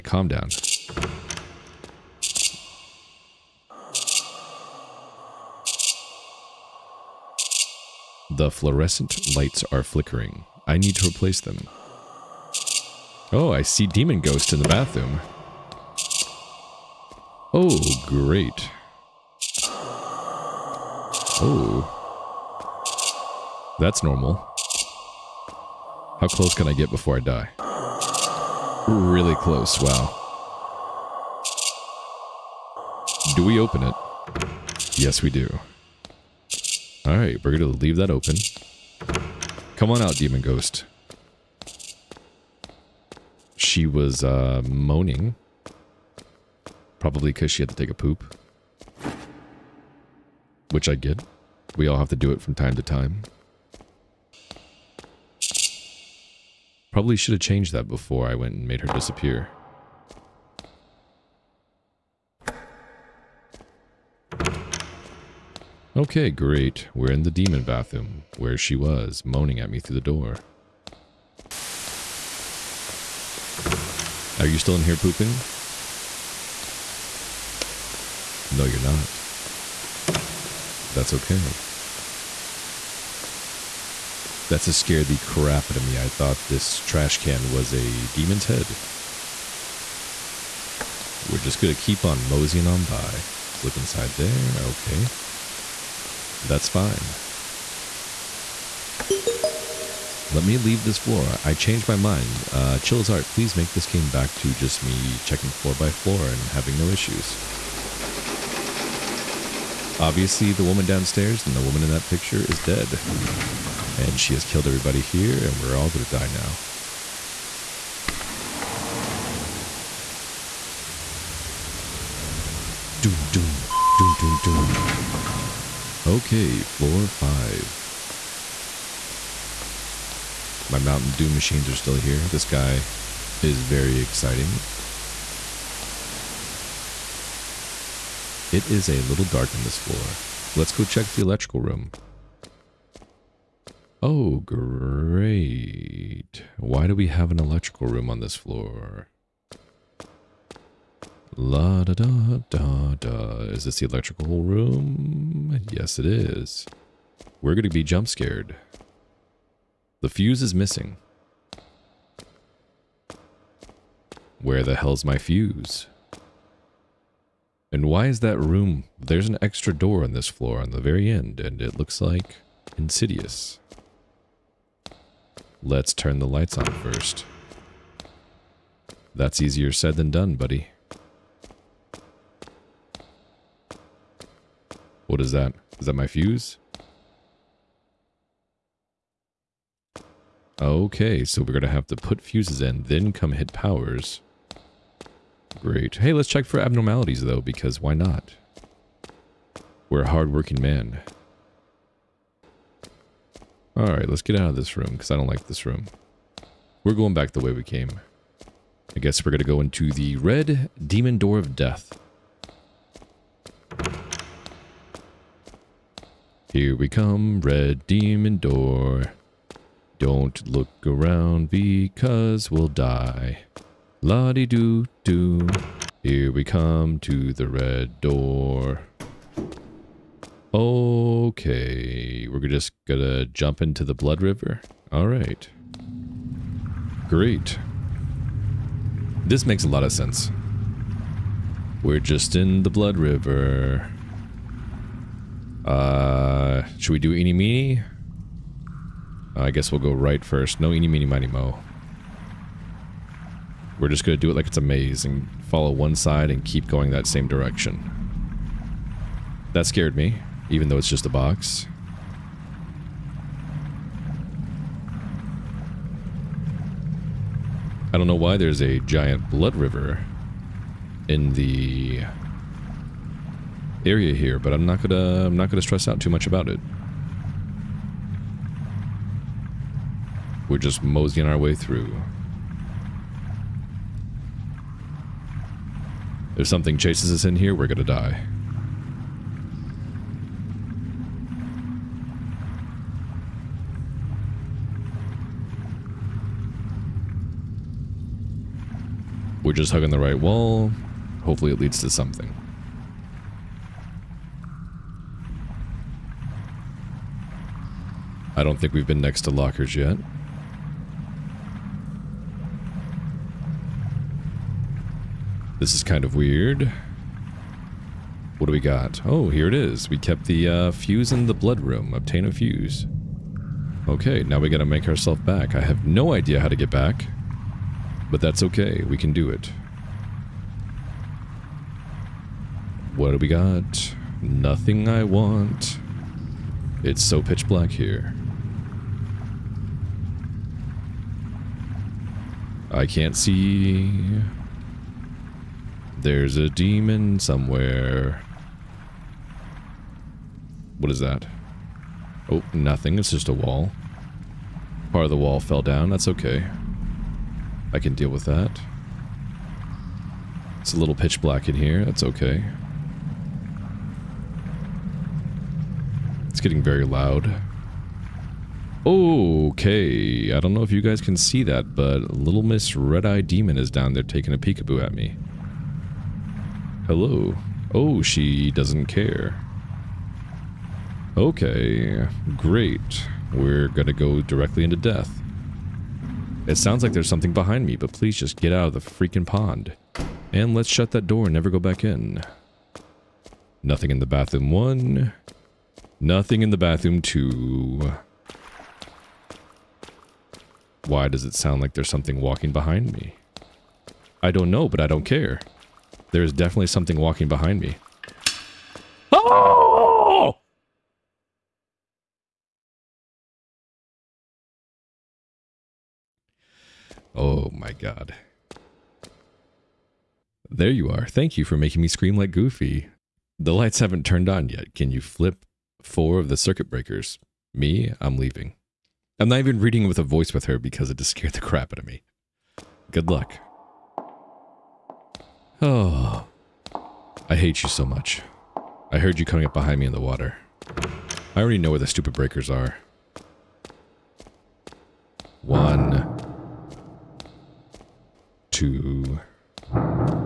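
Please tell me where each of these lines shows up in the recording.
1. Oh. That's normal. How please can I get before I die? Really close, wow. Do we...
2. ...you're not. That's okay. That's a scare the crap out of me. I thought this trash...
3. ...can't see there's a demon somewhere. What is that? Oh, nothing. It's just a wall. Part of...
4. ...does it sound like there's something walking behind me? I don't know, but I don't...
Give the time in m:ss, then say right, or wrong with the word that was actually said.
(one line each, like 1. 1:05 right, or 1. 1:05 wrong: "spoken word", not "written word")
1. 0:21 wrong: "close", not "please"
2. 1:18 right
3. 5:42 right
4. 6:41 right.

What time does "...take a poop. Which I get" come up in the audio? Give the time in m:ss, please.
0:47.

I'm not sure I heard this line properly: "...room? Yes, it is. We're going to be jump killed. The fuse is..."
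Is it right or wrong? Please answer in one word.
wrong.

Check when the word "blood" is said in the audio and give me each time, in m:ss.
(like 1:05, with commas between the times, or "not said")
3:53, 4:02, 4:29, 5:21.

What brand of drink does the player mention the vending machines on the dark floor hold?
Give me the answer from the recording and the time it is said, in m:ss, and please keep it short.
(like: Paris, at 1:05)
Mountain Dew, at 2:10.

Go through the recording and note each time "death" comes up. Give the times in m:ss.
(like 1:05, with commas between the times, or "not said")
3:31, 6:24.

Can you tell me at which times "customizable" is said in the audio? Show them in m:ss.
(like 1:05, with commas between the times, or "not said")
not said.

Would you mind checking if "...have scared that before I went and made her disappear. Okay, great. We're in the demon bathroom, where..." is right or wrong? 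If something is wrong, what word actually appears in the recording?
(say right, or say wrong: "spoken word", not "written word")
wrong: "changed", not "scared".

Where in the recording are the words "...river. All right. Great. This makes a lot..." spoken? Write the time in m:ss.
3:54.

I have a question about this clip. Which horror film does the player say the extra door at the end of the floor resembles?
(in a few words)
Insidious.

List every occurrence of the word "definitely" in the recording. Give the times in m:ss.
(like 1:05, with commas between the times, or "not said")
6:46.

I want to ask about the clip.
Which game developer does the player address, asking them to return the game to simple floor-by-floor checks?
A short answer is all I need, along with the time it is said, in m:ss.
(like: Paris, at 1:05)
Chilla's Art, at 1:42.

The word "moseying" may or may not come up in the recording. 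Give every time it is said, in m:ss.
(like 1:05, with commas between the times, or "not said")
1:32, 4:40.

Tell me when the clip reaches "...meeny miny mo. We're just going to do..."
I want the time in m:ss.
4:10.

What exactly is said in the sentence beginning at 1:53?
And she has killed everybody here, and we're all going to die now.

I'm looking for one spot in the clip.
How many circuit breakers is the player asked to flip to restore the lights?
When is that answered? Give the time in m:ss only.
7:05.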